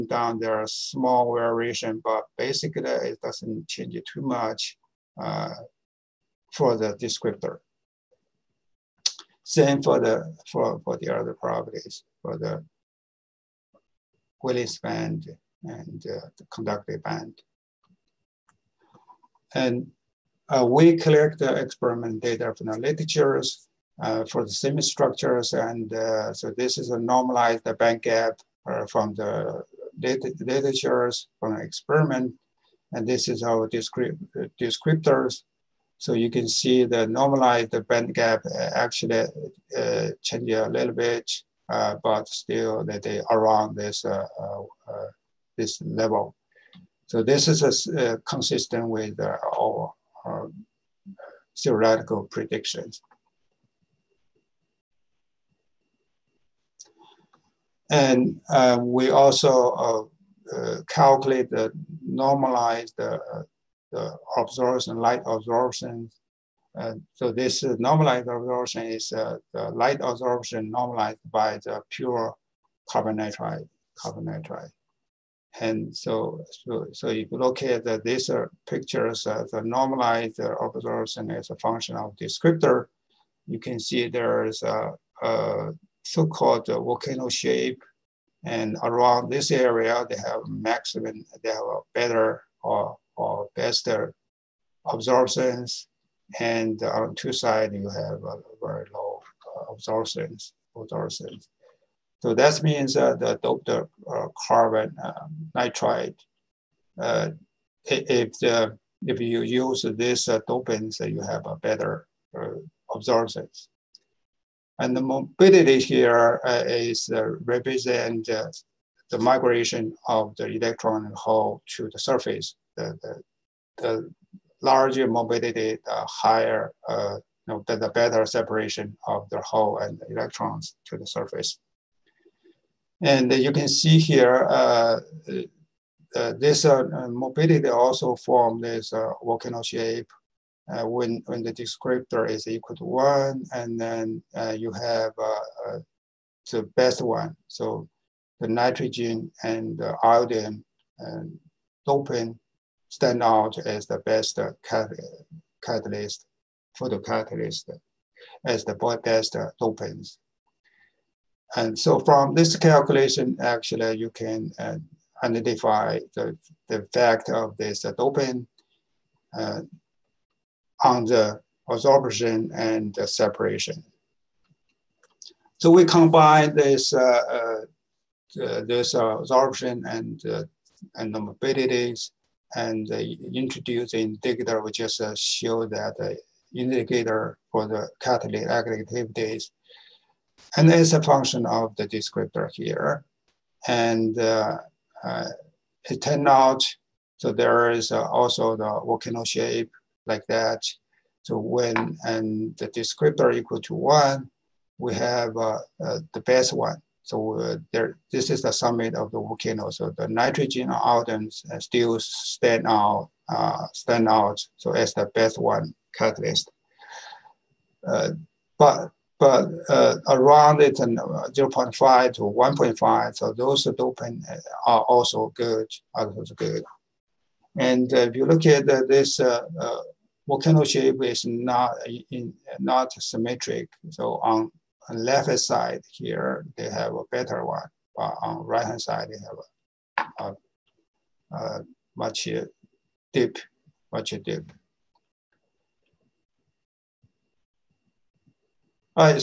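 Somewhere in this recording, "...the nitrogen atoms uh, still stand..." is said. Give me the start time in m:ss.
3:29.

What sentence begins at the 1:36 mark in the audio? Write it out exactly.
And on two sides, you have a very low uh, absorptions, absorptions.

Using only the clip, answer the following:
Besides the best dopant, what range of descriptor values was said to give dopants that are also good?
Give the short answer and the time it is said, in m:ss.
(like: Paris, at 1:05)
0.5 to 1.5, at 3:40.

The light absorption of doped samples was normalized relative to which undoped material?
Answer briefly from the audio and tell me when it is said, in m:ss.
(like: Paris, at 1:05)
pure carbon nitride, at 1:11.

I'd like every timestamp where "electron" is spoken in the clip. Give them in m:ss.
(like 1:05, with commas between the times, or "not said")
2:00, 2:10.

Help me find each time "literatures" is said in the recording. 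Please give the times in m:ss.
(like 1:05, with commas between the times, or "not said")
0:22, 0:30.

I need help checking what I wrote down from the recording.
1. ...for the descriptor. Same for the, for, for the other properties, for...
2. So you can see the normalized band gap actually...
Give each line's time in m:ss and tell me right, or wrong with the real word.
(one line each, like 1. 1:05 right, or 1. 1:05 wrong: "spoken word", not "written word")
1. 0:06 right
2. 0:35 right.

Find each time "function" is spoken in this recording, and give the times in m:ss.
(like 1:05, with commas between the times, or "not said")
1:21, 3:11.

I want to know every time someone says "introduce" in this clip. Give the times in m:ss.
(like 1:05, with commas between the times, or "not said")
3:03.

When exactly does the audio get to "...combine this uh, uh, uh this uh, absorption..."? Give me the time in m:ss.
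2:55.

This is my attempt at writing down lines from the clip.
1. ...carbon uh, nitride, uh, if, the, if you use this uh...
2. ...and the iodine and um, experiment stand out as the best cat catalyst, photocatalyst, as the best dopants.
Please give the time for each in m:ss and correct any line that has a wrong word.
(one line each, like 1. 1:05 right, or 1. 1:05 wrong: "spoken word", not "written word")
1. 1:44 right
2. 2:29 wrong: "dopant", not "experiment".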